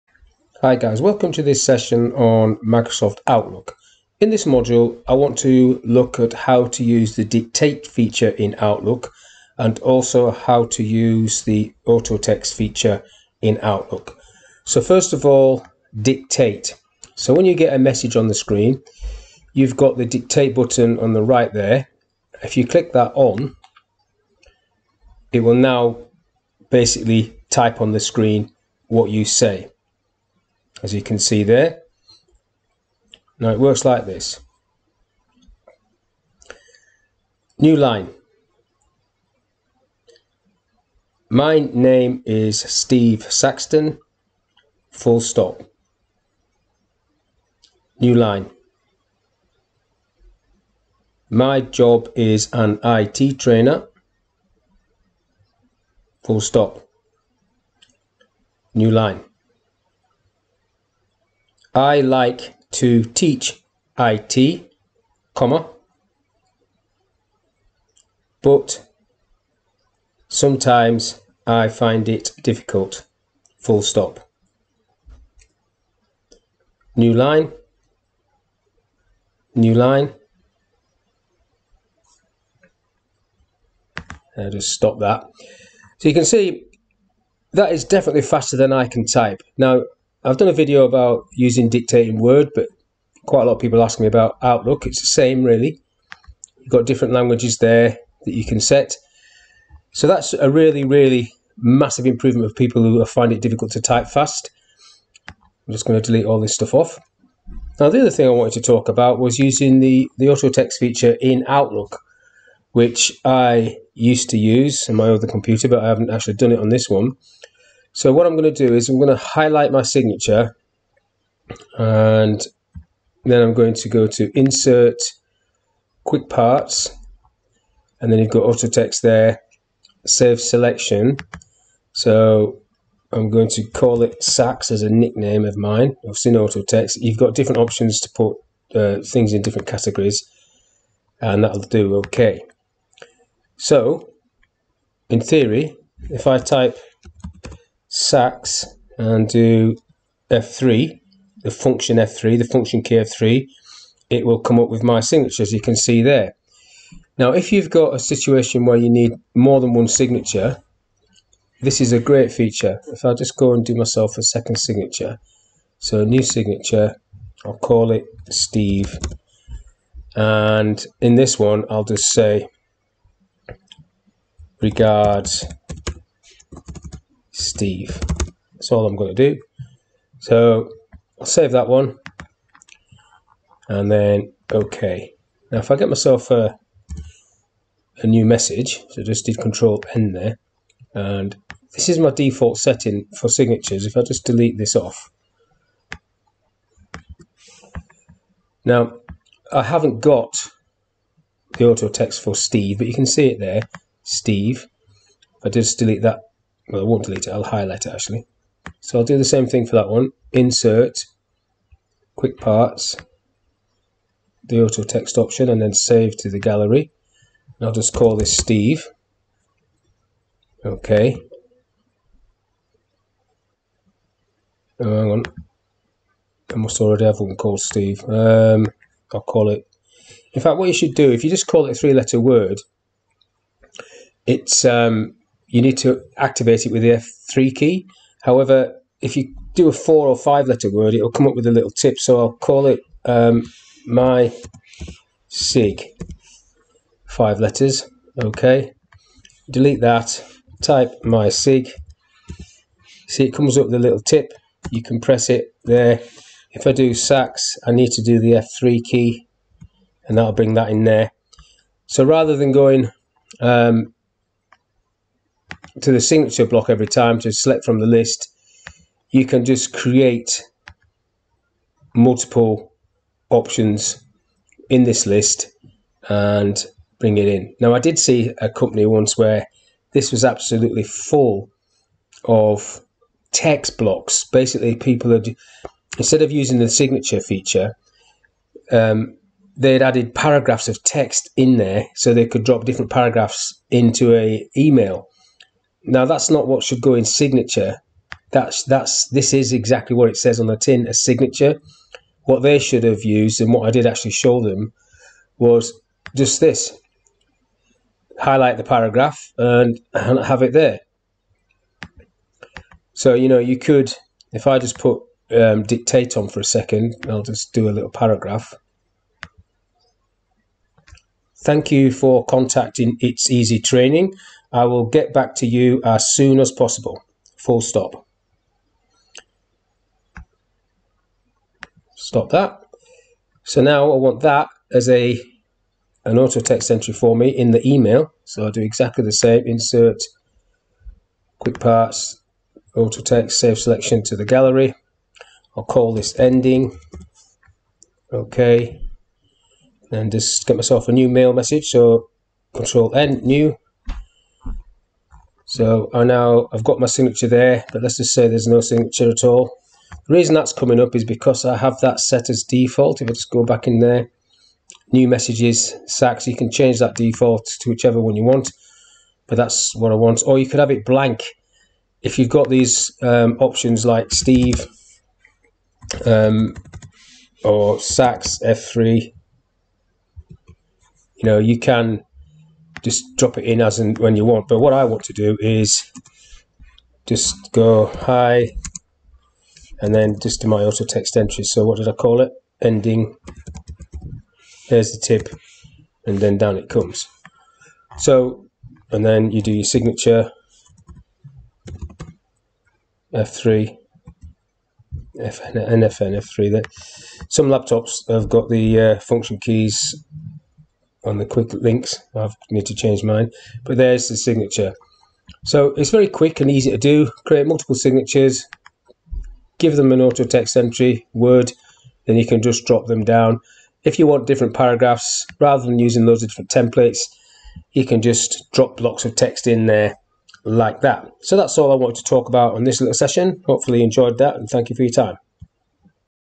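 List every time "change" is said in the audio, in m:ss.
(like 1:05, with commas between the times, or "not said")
6:06, 6:52.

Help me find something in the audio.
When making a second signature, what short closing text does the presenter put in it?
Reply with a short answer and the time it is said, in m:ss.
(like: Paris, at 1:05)
Regards Steve, at 2:54.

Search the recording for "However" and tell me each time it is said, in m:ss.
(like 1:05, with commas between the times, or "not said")
3:58.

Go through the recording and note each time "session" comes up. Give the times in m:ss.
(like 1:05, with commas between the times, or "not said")
0:01, 7:12.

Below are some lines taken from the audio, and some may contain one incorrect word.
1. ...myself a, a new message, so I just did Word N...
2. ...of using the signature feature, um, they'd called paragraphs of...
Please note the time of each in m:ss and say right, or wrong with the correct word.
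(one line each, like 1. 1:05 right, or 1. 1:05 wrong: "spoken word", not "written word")
1. 3:05 wrong: "Control", not "Word"
2. 4:46 wrong: "added", not "called".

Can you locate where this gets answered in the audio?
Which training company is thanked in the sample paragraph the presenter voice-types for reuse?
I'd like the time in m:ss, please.
5:22.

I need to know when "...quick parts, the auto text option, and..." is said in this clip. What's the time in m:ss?
3:32.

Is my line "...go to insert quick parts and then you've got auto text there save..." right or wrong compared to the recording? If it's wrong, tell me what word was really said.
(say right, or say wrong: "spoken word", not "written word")
right.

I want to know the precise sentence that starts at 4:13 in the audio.
See, it comes up with a little tip.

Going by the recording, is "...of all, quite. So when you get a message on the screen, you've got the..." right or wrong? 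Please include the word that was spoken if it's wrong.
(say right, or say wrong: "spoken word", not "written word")
wrong: "dictate", not "quite".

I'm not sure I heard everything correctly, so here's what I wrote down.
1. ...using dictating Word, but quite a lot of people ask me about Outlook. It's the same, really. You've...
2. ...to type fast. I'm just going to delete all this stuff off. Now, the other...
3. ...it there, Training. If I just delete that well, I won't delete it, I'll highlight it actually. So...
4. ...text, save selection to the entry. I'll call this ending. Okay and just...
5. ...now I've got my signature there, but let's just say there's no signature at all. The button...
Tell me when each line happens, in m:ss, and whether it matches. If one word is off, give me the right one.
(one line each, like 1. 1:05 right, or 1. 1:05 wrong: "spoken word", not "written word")
1. 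1:31 right
2. 1:43 right
3. 3:23 wrong: "Steve", not "Training"
4. 5:43 wrong: "gallery", not "entry"
5. 5:56 wrong: "reason", not "button".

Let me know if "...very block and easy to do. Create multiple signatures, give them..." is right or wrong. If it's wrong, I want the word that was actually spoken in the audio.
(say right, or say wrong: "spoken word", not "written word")
wrong: "quick", not "block".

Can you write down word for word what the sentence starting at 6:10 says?
Or you could have it blank.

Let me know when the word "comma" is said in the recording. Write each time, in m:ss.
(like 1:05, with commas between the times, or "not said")
1:05.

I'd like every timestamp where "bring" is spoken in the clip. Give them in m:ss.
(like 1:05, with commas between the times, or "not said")
4:20, 4:36.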